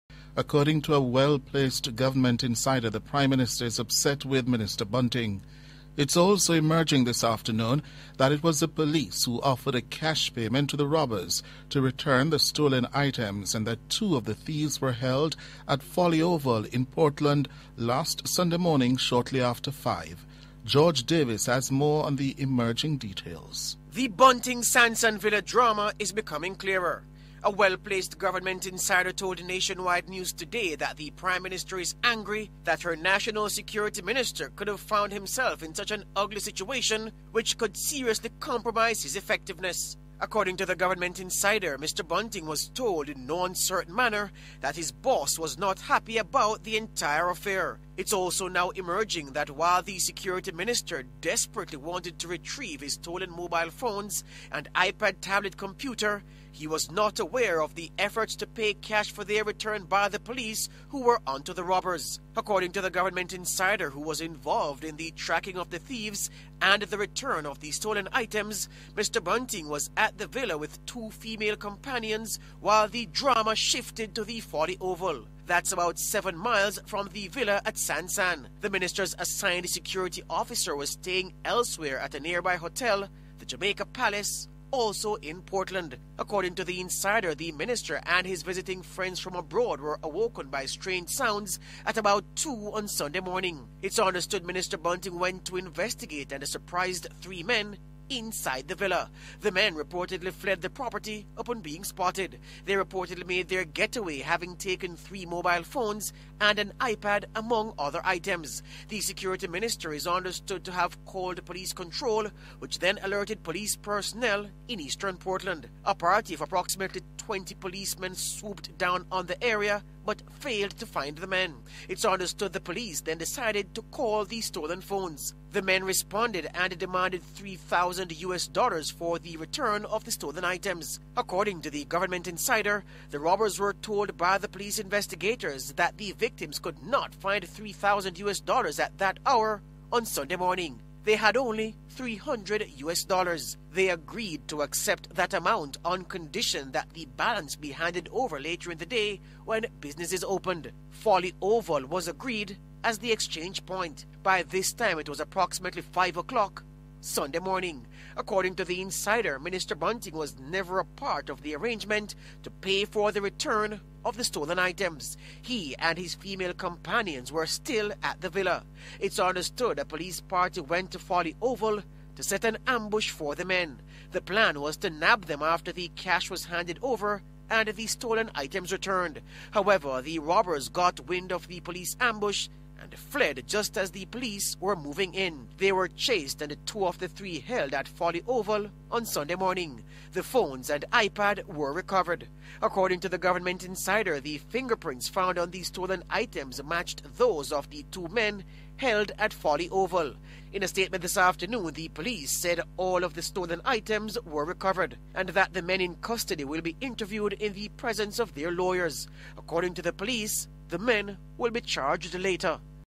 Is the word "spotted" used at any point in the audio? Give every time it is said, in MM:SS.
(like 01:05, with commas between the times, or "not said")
01:41.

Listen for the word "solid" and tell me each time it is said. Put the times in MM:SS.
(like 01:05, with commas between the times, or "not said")
not said.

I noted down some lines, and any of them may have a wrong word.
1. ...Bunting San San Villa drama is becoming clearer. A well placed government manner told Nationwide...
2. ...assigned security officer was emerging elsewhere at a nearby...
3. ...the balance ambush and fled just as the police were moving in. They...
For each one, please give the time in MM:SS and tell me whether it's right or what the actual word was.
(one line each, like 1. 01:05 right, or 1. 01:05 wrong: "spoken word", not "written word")
1. 00:24 wrong: "insider", not "manner"
2. 01:19 wrong: "staying", not "emerging"
3. 03:01 wrong: "police", not "balance".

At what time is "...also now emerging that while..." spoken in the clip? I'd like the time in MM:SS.
00:48.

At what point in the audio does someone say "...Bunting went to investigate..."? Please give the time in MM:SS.
01:34.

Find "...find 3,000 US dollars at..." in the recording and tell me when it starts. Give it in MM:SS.
02:17.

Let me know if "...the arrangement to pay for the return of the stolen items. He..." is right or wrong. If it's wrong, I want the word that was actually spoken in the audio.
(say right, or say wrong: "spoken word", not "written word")
right.